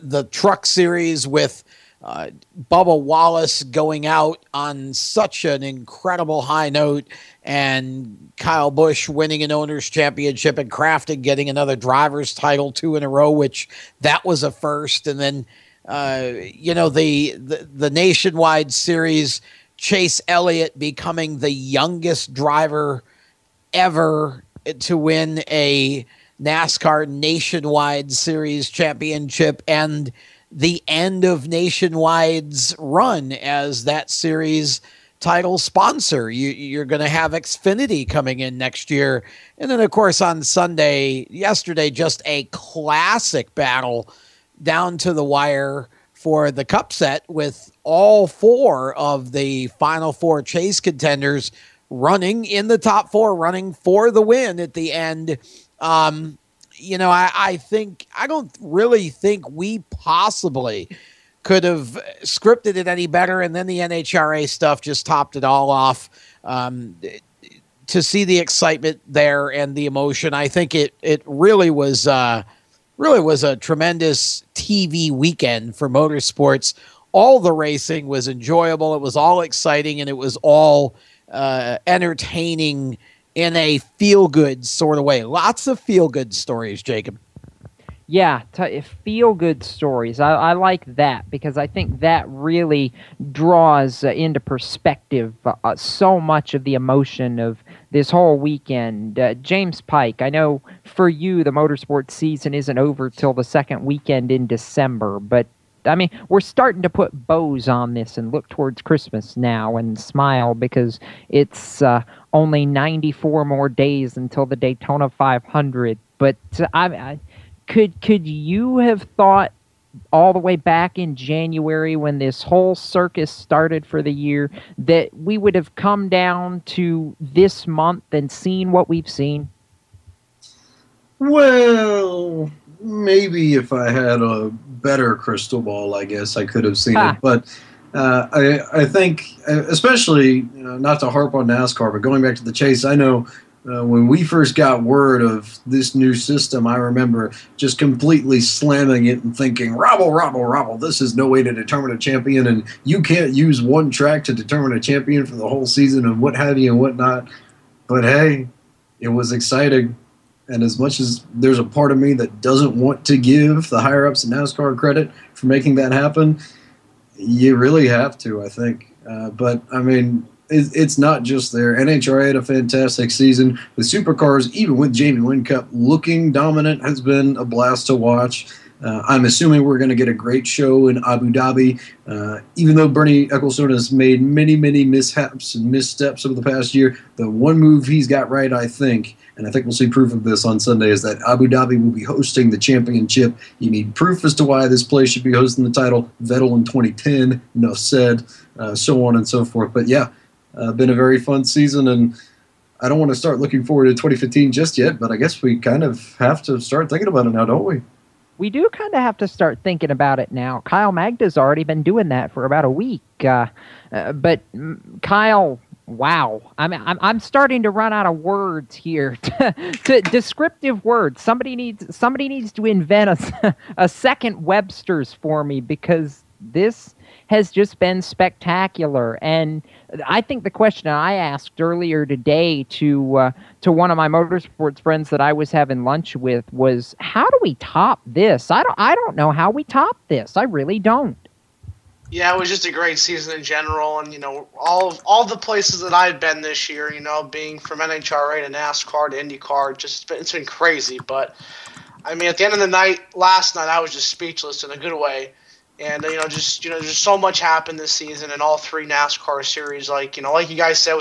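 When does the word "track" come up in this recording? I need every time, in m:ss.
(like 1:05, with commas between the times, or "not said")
2:33.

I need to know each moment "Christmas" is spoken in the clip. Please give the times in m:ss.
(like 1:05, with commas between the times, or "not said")
1:48.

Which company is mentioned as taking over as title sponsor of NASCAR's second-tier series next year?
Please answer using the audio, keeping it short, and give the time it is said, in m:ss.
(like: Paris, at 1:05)
Xfinity, at 0:37.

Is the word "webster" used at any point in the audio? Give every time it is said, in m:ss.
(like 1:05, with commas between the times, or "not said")
3:44.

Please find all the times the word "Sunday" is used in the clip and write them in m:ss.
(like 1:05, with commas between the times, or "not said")
0:40, 3:10.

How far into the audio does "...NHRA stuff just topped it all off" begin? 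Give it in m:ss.
1:03.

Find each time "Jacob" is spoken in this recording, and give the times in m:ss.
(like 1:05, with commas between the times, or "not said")
1:26.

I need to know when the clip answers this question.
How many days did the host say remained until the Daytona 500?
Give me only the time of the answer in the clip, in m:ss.
1:52.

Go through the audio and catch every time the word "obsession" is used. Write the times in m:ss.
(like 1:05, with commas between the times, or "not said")
not said.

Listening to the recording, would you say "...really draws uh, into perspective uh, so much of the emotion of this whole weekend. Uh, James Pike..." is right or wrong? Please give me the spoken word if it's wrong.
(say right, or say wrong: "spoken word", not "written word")
right.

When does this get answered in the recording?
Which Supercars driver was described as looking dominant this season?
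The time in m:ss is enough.
2:54.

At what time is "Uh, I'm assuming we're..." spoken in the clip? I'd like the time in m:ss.
2:58.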